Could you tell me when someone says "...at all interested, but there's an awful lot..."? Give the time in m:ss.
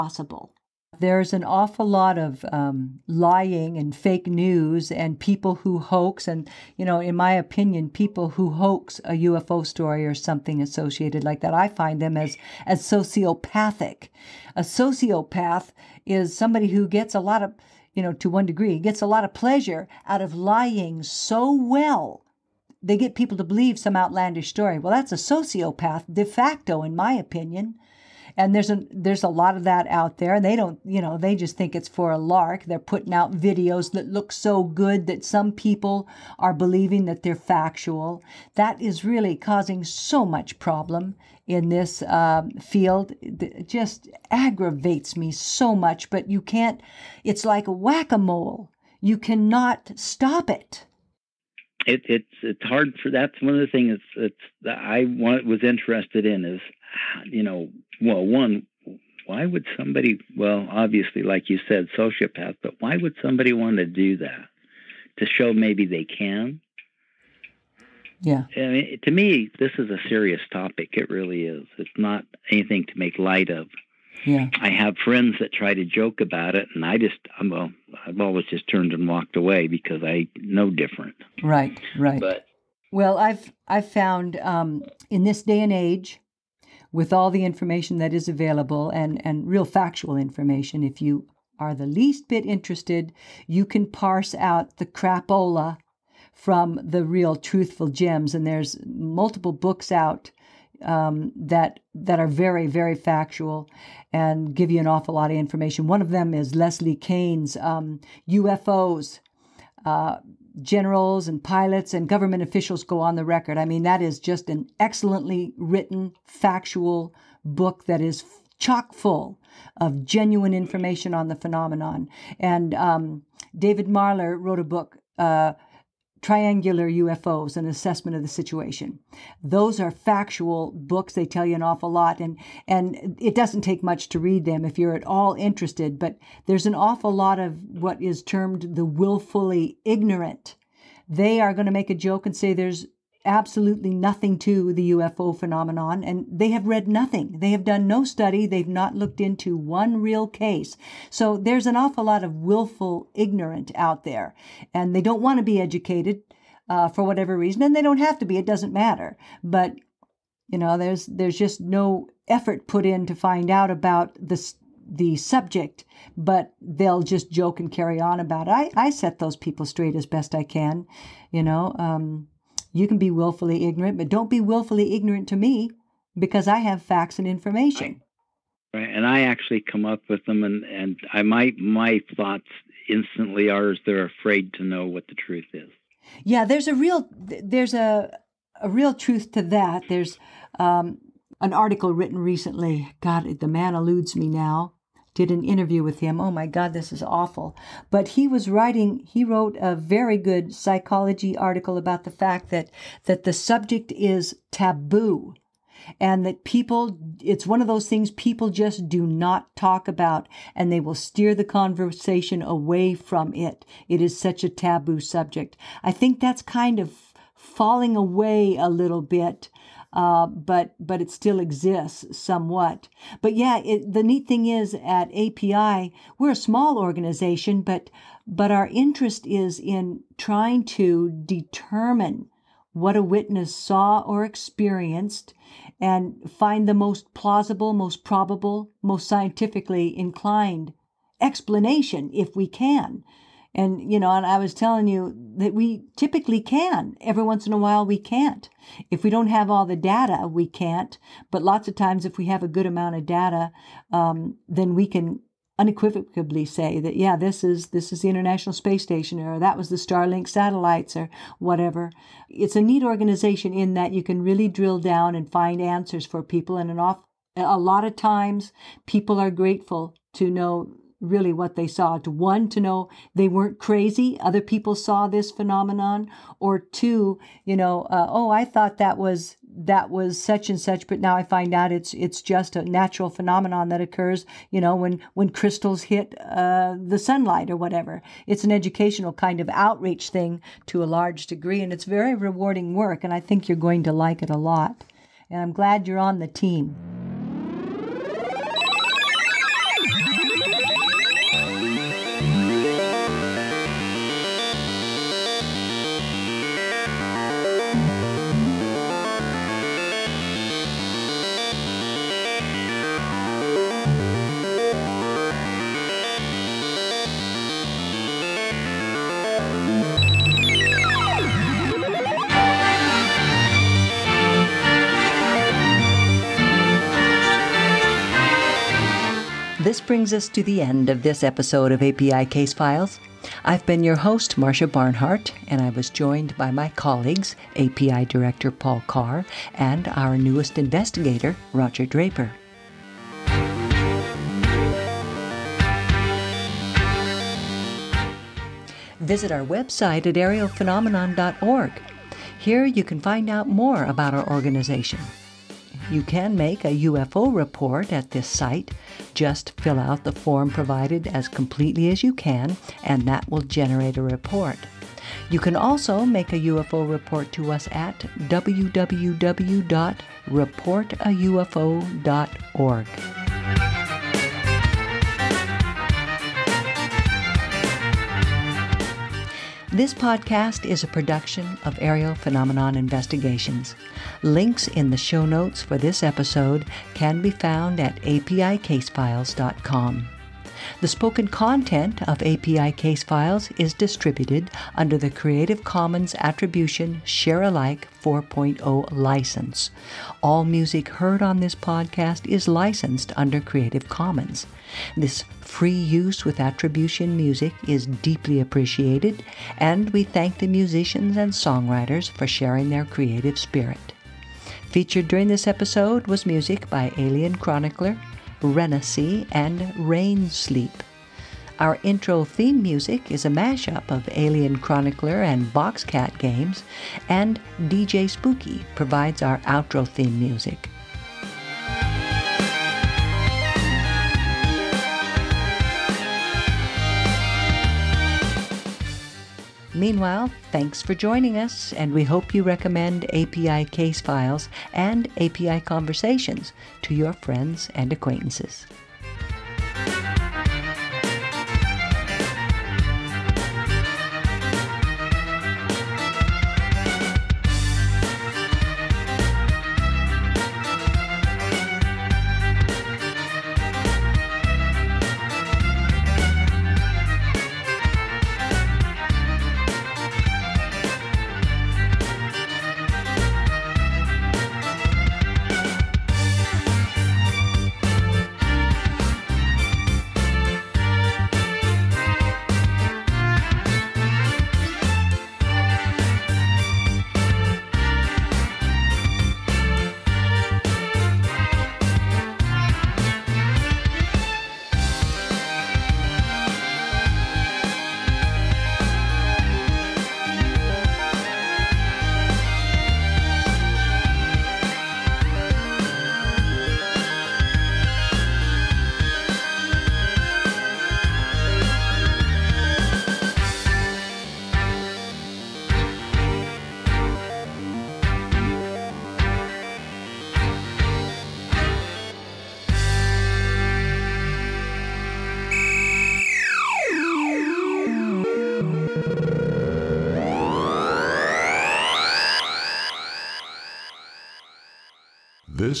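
2:14.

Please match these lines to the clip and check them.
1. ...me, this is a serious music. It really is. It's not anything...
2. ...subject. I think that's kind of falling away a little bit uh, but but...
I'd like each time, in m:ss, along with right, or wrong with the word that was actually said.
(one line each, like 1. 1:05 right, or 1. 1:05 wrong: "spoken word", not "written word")
1. 1:09 wrong: "topic", not "music"
2. 3:35 right.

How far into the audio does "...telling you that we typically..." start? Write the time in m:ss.
4:04.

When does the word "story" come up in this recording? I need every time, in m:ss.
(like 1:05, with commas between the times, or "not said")
0:09, 0:24.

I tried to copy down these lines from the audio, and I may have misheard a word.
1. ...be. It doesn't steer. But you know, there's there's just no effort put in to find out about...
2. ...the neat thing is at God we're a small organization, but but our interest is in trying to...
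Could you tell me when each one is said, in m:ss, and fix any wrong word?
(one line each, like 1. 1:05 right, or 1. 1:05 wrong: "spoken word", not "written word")
1. 2:38 wrong: "matter", not "steer"
2. 3:43 wrong: "API", not "God".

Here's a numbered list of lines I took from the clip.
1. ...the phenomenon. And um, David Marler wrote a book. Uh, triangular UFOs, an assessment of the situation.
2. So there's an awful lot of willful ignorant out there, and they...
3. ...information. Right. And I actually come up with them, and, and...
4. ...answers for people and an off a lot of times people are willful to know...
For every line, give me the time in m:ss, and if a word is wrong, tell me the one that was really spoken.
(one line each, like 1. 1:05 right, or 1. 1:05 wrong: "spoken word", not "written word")
1. 2:01 right
2. 2:31 right
3. 2:57 right
4. 4:25 wrong: "grateful", not "willful".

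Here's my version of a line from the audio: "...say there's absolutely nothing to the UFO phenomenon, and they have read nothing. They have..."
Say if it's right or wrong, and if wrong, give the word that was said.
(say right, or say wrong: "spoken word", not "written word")
right.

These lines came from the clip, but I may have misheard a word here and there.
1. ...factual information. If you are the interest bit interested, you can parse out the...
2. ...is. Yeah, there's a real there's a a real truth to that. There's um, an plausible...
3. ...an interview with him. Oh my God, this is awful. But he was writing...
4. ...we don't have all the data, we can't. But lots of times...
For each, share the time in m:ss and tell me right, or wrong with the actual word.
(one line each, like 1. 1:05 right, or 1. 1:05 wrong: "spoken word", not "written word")
1. 1:29 wrong: "least", not "interest"
2. 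3:05 wrong: "article", not "plausible"
3. 3:15 right
4. 4:09 right.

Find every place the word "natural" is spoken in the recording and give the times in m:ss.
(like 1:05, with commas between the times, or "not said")
4:42.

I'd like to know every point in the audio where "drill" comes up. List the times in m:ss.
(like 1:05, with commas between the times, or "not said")
4:24.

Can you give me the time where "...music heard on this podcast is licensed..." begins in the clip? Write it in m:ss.
6:40.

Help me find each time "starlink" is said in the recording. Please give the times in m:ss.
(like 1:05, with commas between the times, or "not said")
4:19.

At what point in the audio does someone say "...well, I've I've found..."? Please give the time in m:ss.
1:22.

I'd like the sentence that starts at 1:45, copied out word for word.
One of them is Leslie Kean's um, UFOs.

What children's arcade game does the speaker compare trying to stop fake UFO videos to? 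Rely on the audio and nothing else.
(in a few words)
whack a mole.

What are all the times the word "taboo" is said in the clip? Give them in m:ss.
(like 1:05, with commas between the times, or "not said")
3:24, 3:34.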